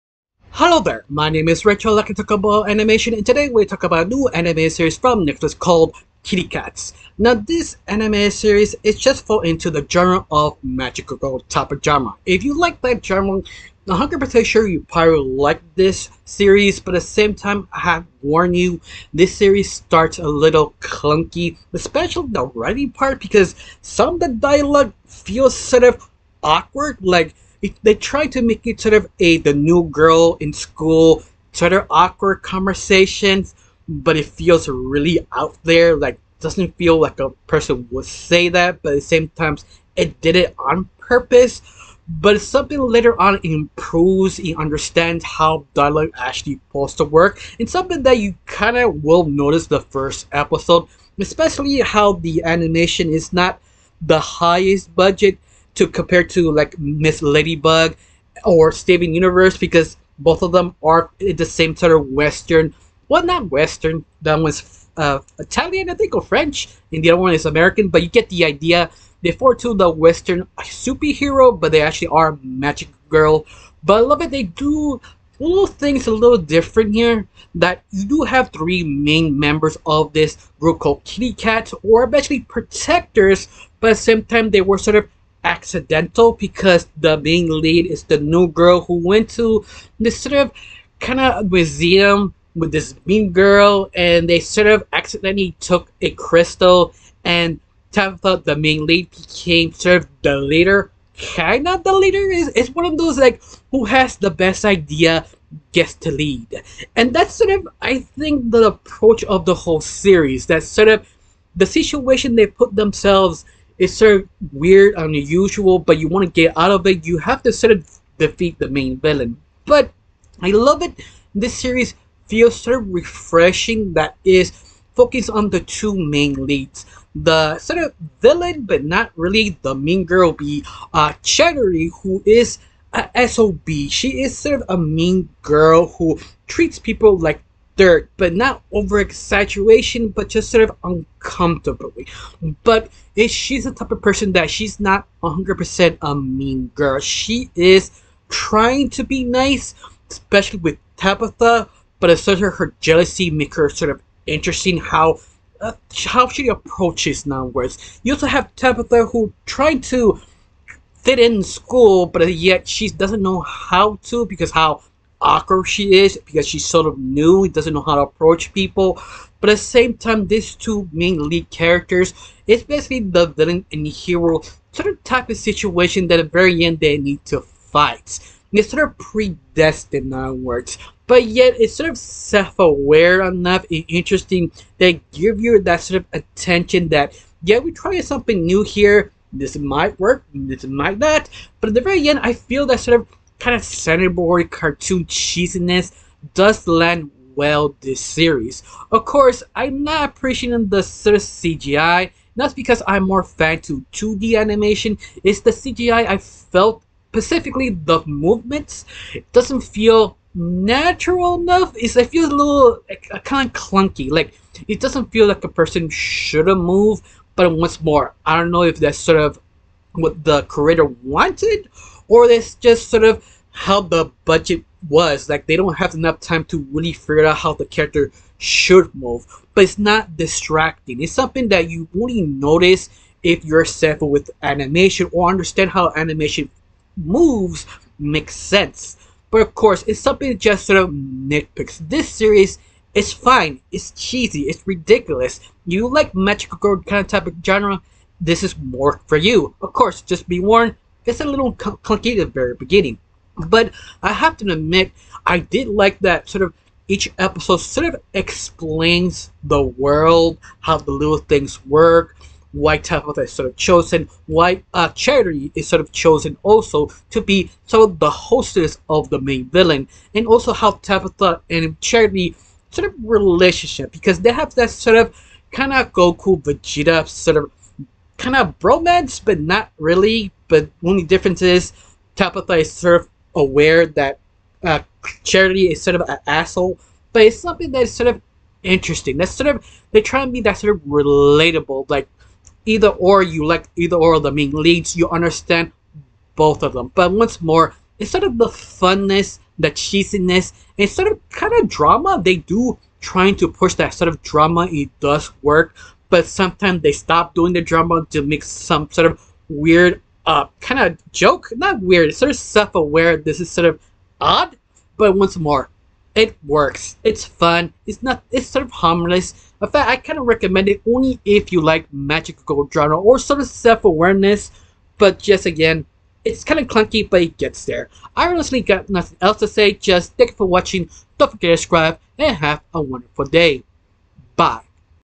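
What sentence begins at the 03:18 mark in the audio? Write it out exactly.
Of course, I'm not appreciating the CGI.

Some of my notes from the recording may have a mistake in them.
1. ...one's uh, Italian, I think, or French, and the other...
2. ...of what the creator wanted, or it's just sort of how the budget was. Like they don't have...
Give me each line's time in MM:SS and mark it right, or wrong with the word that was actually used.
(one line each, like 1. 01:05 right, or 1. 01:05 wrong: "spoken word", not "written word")
1. 01:04 right
2. 03:39 right.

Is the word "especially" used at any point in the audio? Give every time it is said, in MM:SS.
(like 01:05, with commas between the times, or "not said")
00:21, 00:51, 02:30.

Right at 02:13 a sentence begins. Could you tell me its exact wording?
She is sort of a mean girl who treats people like dirt, but not over exaggeration, but just sort of uncomfortably.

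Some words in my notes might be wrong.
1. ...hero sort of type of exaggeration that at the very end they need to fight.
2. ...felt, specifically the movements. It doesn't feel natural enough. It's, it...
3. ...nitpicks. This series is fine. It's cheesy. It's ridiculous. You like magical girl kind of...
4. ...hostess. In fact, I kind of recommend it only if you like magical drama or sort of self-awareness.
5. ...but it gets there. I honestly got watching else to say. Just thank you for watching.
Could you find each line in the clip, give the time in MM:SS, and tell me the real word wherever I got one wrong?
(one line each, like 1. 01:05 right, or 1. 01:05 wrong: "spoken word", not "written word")
1. 02:53 wrong: "situation", not "exaggeration"
2. 03:26 right
3. 04:00 right
4. 05:18 wrong: "harmless", not "hostess"
5. 05:27 wrong: "nothing", not "watching".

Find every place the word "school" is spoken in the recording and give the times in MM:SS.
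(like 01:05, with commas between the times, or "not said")
00:30, 02:41.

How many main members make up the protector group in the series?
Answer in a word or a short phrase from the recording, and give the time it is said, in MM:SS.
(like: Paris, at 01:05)
3, at 01:18.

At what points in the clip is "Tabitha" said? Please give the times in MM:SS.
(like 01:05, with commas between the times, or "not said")
01:37, 02:30, 02:38, 04:22, 04:30, 04:42.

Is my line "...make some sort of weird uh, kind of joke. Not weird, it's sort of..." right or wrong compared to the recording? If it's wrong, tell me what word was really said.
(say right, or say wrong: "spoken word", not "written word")
right.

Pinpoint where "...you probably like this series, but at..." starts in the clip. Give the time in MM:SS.
00:14.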